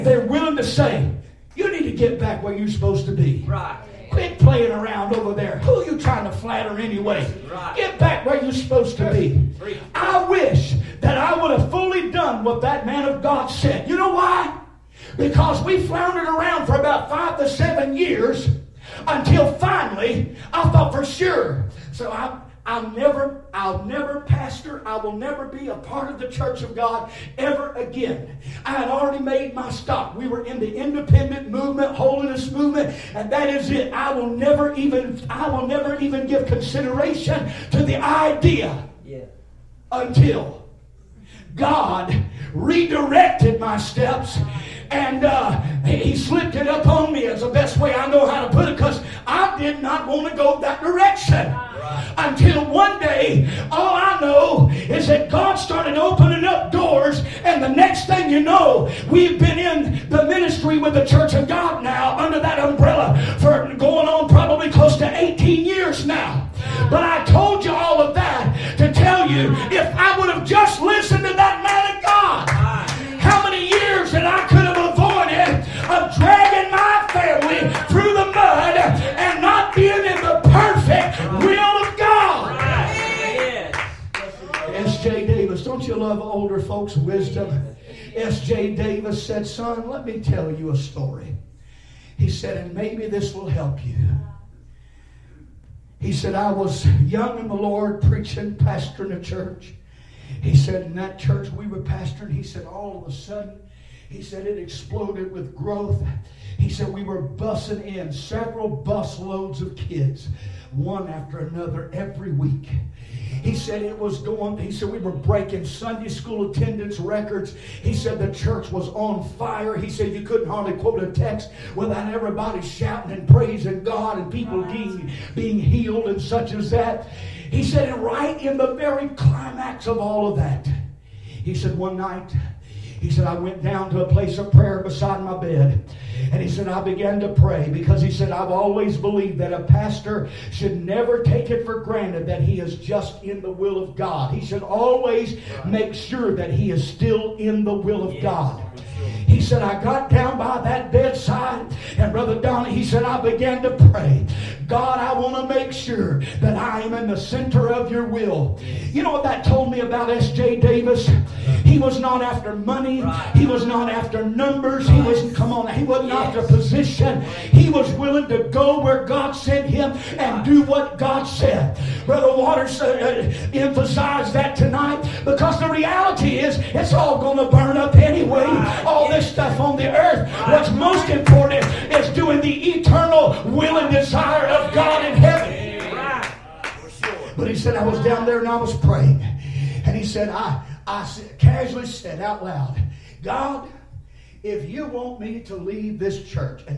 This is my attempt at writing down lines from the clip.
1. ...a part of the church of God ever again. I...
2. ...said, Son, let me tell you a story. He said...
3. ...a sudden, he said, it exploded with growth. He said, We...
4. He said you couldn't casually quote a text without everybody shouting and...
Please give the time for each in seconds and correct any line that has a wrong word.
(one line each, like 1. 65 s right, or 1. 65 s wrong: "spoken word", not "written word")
1. 25 s right
2. 89 s right
3. 103 s right
4. 119 s wrong: "hardly", not "casually".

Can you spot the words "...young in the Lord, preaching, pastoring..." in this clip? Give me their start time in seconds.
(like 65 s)
97 s.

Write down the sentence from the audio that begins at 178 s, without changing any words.
All this this stuff on the earth.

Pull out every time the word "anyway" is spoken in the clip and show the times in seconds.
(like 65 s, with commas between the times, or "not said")
6 s, 177 s.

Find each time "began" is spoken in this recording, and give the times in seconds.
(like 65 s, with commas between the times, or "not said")
136 s, 153 s.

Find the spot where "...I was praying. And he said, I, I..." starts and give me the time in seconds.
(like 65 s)
188 s.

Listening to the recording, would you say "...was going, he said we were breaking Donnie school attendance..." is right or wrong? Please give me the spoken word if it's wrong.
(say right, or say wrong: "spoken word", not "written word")
wrong: "Sunday", not "Donnie".